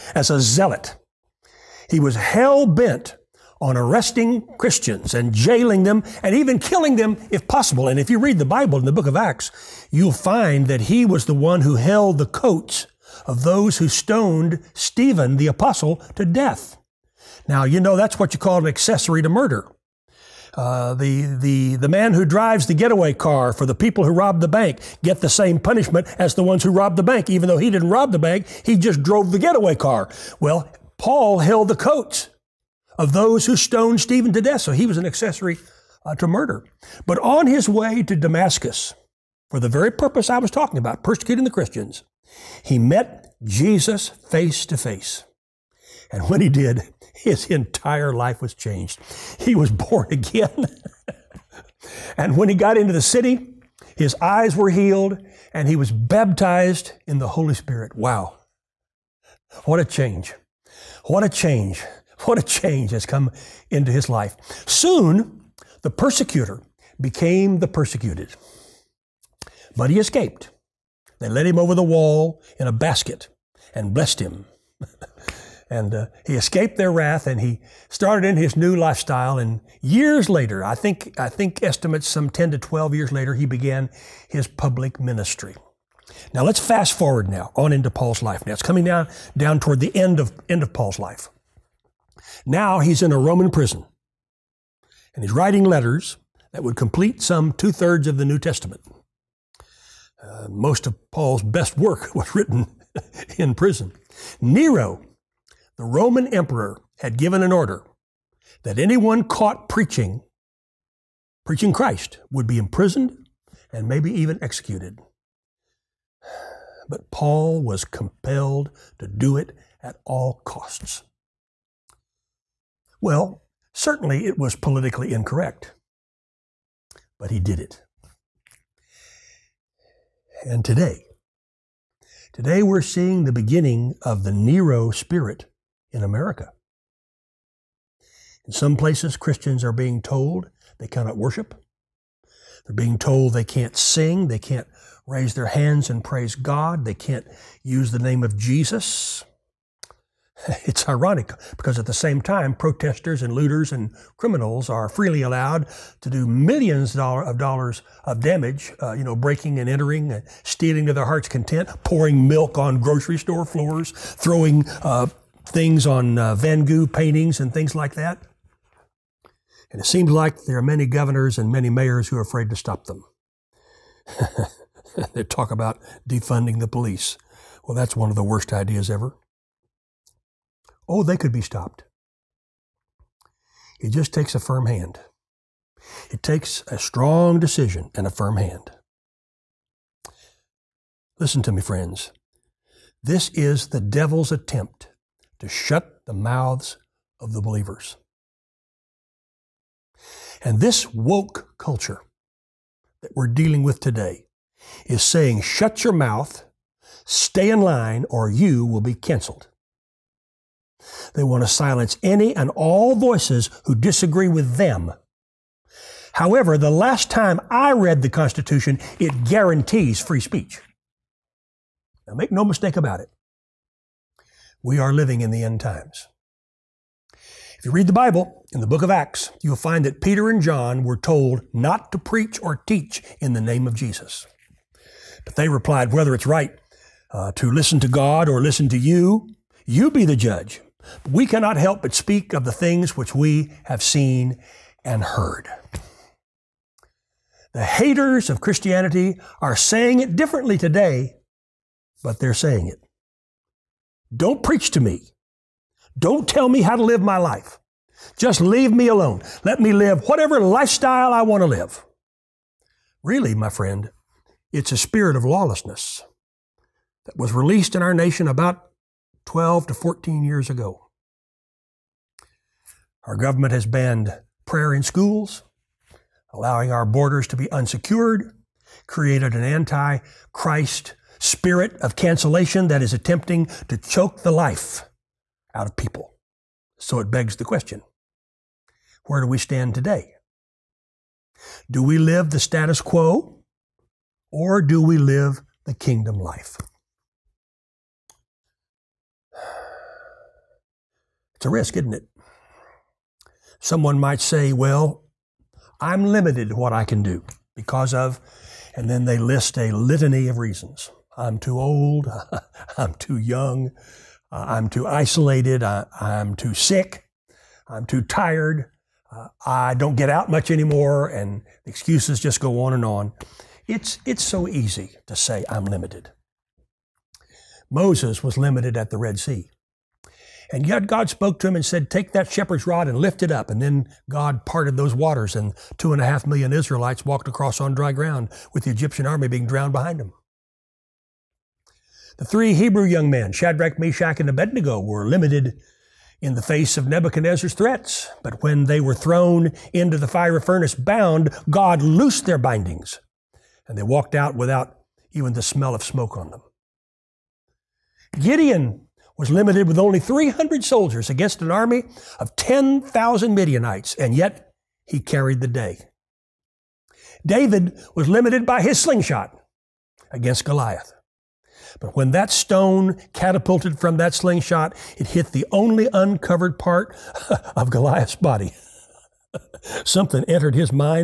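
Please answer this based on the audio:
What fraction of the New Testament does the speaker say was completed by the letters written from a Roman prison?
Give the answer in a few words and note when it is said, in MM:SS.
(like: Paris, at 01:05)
two thirds, at 01:37.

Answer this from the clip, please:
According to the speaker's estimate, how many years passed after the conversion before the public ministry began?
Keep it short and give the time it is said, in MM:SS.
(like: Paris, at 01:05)
10 to 12 years, at 01:22.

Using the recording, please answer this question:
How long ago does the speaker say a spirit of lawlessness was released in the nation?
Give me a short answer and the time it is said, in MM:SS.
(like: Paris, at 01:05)
12 to 14 years, at 04:29.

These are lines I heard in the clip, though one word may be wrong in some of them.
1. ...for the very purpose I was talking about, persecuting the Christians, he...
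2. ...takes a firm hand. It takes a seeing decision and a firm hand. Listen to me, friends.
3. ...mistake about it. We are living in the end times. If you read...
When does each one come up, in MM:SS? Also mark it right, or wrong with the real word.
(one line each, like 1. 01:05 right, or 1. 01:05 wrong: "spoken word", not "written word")
1. 00:39 right
2. 03:04 wrong: "strong", not "seeing"
3. 03:42 right.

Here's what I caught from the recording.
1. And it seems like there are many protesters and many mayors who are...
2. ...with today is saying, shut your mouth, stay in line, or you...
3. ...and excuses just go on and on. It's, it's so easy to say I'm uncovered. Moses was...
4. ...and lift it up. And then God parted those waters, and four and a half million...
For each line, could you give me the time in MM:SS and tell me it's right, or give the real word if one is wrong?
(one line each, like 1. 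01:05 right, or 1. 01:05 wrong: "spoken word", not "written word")
1. 02:49 wrong: "governors", not "protesters"
2. 03:23 right
3. 05:21 wrong: "limited", not "uncovered"
4. 05:32 wrong: "two", not "four".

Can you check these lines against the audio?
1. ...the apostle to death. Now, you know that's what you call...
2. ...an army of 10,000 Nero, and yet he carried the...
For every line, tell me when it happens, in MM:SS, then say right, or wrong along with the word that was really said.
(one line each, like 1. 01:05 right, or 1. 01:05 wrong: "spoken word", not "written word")
1. 00:15 right
2. 06:01 wrong: "Midianites", not "Nero".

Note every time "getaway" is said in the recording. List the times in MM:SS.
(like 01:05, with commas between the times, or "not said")
00:22, 00:29.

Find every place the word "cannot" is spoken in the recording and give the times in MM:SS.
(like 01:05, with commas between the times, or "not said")
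02:20, 04:01.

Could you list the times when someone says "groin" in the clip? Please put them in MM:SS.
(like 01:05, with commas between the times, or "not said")
not said.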